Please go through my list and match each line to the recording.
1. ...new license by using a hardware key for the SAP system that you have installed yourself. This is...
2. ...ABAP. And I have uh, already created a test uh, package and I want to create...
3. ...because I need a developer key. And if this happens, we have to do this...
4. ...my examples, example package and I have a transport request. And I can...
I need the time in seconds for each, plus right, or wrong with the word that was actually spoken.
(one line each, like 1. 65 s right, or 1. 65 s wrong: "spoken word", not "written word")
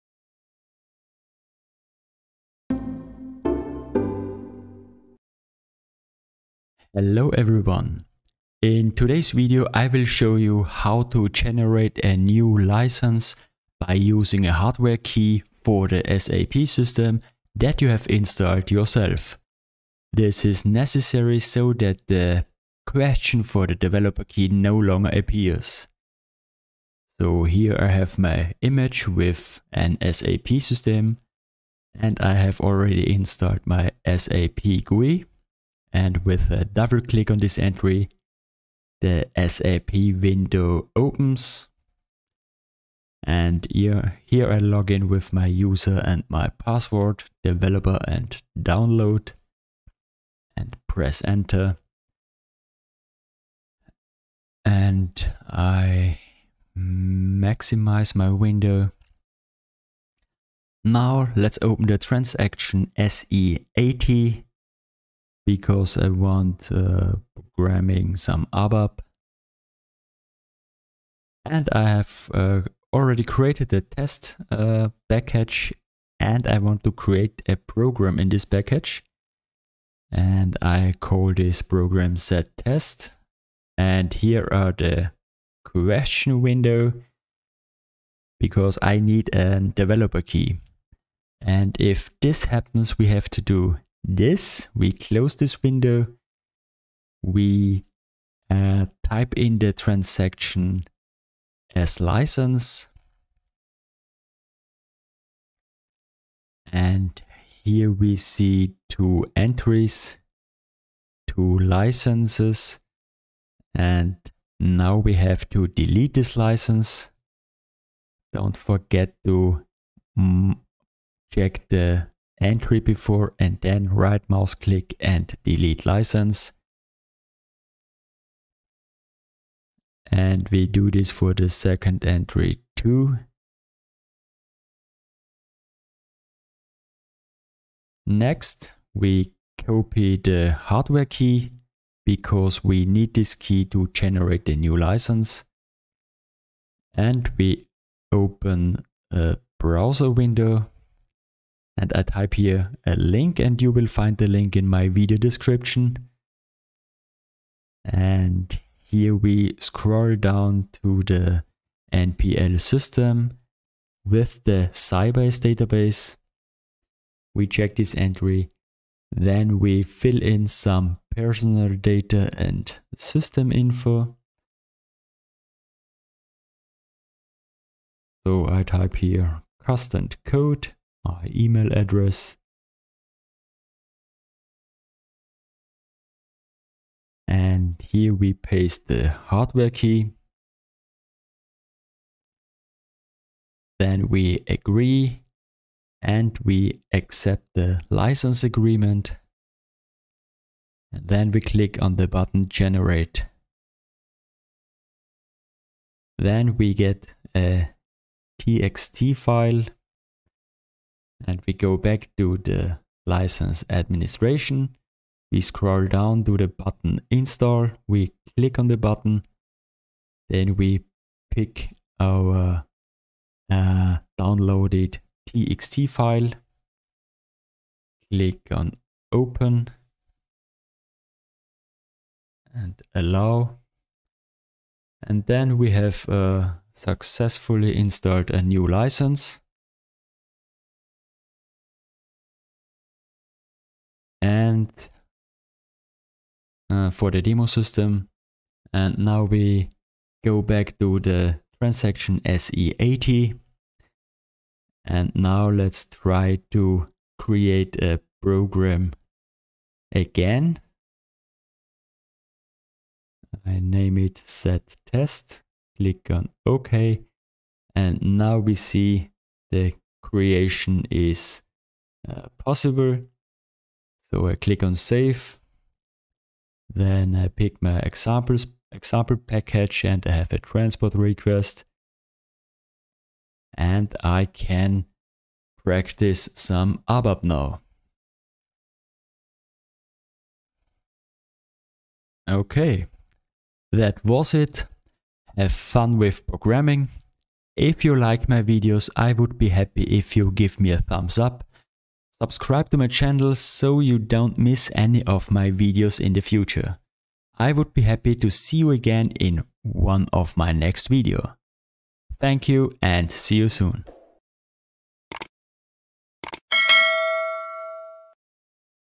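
1. 12 s right
2. 68 s right
3. 88 s right
4. 277 s right.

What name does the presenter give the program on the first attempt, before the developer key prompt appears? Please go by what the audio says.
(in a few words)
ZTEST.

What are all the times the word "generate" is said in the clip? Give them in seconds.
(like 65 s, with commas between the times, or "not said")
11 s, 143 s, 202 s.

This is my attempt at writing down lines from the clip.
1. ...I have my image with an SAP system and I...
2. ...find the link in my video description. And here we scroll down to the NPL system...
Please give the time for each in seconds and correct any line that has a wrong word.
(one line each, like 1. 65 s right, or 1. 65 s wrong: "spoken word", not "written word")
1. 27 s right
2. 153 s right.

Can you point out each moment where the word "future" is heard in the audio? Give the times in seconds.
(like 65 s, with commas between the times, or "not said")
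306 s.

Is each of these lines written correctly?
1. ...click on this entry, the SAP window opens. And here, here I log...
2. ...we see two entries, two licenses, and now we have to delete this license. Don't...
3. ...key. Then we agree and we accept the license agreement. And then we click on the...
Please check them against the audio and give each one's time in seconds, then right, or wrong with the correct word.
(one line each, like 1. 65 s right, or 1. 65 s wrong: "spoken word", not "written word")
1. 37 s right
2. 107 s right
3. 189 s right.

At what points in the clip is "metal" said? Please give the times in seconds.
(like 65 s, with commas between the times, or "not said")
not said.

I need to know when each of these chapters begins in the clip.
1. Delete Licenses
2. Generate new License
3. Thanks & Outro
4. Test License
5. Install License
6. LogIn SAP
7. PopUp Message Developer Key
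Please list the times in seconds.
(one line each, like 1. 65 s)
1. 115 s
2. 137 s
3. 291 s
4. 254 s
5. 205 s
6. 35 s
7. 84 s.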